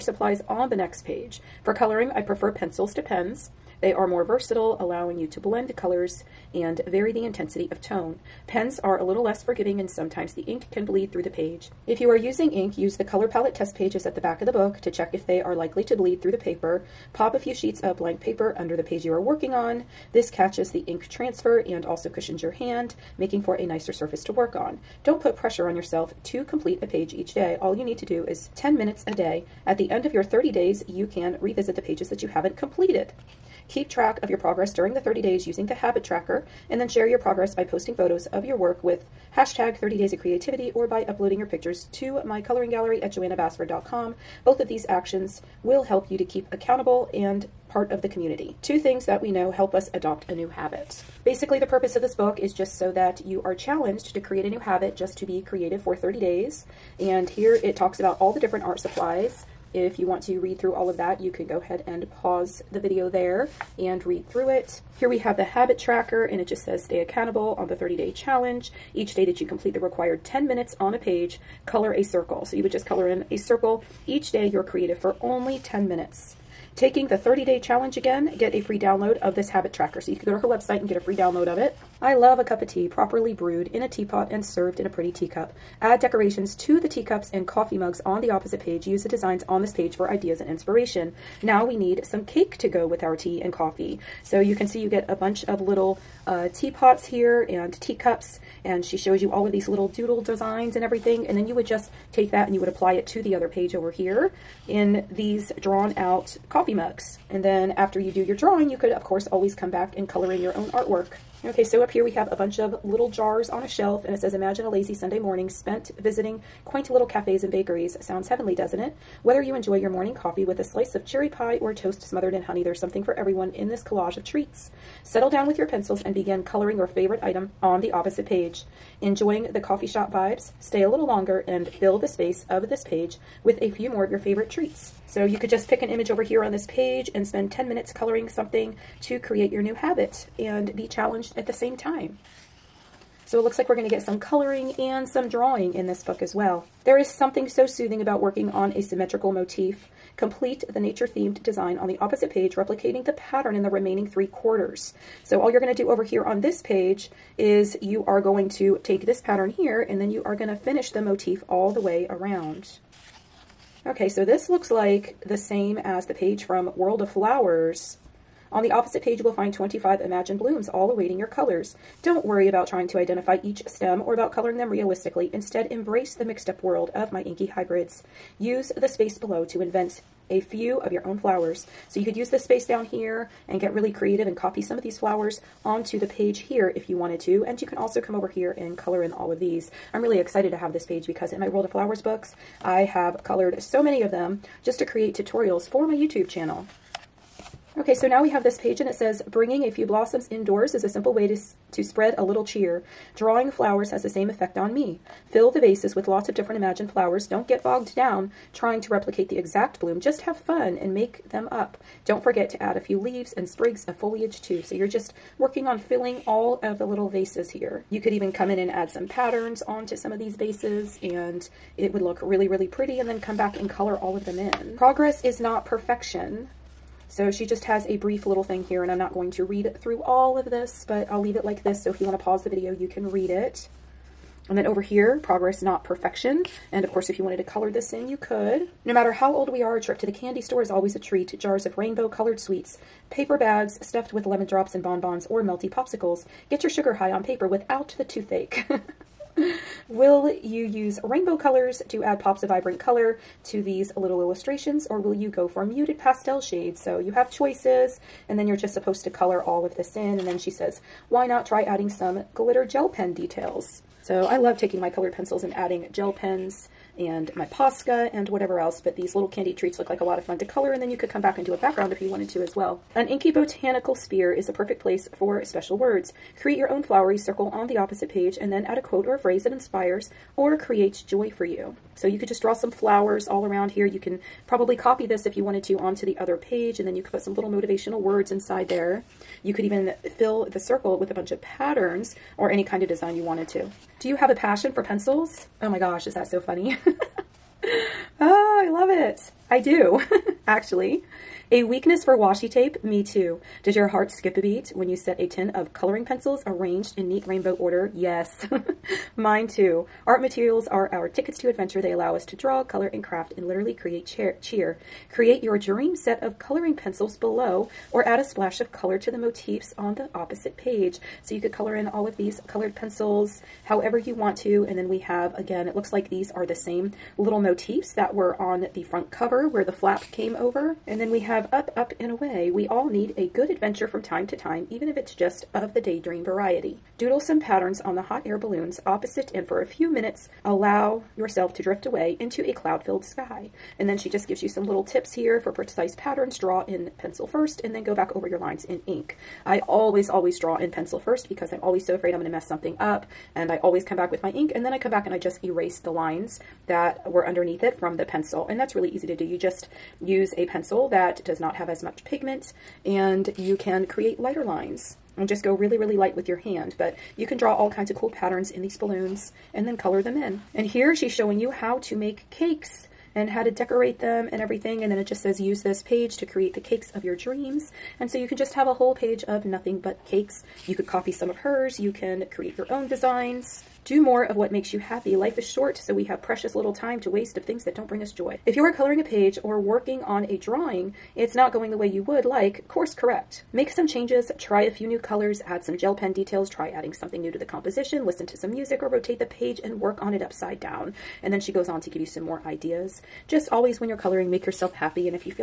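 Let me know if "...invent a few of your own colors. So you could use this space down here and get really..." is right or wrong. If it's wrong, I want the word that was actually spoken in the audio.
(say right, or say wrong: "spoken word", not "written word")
wrong: "flowers", not "colors".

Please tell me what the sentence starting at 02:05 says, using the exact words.
Settle down with your pencils and begin coloring your favorite item on the opposite page.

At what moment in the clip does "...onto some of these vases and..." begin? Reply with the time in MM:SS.
03:39.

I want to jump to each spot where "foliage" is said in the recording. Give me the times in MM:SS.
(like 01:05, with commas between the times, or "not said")
03:33.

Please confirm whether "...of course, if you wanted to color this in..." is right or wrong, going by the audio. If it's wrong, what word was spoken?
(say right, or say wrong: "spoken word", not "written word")
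right.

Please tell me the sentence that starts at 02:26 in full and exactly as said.
There is something so soothing about working on a symmetrical motif.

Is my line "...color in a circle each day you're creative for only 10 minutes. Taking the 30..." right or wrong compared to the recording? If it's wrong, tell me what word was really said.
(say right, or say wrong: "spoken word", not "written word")
right.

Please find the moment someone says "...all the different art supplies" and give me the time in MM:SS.
00:58.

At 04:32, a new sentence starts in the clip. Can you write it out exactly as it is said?
An inky botanical sphere is a perfect place for special words.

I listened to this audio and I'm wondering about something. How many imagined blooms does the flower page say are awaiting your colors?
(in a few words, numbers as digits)
25.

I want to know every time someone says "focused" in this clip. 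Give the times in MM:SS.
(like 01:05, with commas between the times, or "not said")
not said.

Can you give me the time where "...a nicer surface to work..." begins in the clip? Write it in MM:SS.
00:23.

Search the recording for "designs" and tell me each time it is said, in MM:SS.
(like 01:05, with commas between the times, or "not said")
01:29, 01:40, 02:31, 04:52, 06:22.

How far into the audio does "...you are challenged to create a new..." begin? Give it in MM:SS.
00:53.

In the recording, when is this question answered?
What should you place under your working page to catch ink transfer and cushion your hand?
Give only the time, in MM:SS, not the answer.
00:17.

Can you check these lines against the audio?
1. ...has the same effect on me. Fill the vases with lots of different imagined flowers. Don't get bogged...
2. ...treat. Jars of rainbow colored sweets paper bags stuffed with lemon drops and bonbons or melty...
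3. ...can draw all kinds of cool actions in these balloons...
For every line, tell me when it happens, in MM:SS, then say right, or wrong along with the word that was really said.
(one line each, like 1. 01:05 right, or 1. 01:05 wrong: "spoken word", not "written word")
1. 03:23 right
2. 04:00 right
3. 06:07 wrong: "patterns", not "actions".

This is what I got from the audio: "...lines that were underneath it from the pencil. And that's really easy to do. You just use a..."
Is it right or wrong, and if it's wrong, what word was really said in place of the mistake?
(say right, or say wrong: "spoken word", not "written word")
right.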